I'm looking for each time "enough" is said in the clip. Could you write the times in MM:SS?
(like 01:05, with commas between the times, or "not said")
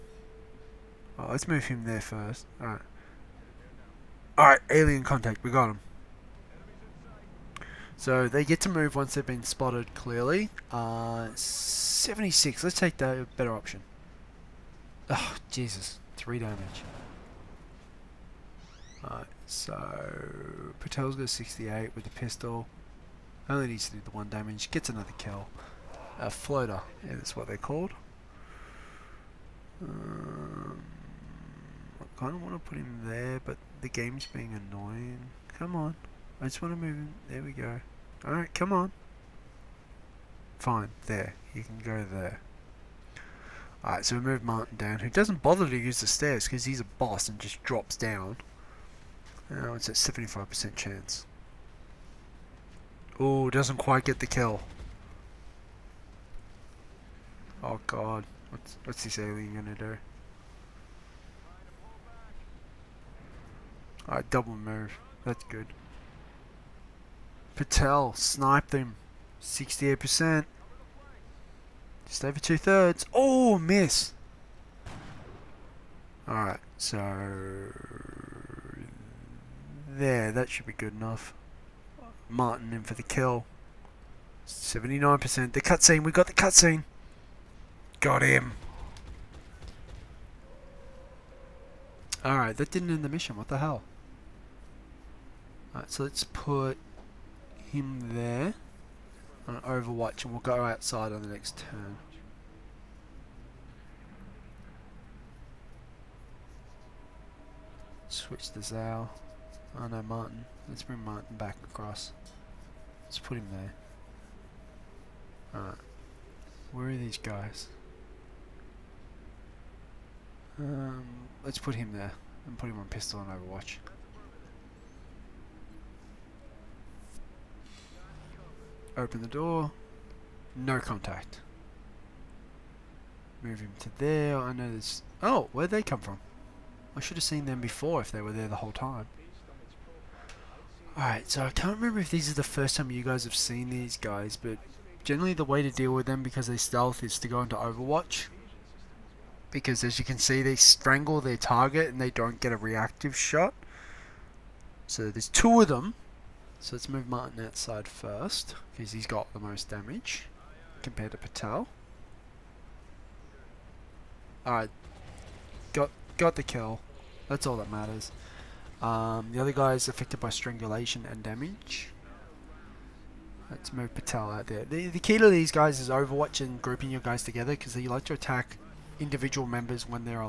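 01:20.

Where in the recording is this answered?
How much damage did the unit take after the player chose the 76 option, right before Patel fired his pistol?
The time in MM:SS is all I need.
00:16.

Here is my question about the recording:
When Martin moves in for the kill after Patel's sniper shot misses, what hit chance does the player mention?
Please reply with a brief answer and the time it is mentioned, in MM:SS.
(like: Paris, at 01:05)
79%, at 01:24.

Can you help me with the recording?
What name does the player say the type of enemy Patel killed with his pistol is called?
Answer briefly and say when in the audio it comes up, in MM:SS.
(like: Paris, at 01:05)
floater, at 00:26.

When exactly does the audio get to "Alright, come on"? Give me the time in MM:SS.
00:38.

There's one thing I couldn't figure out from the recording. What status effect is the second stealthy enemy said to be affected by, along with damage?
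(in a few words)
strangulation.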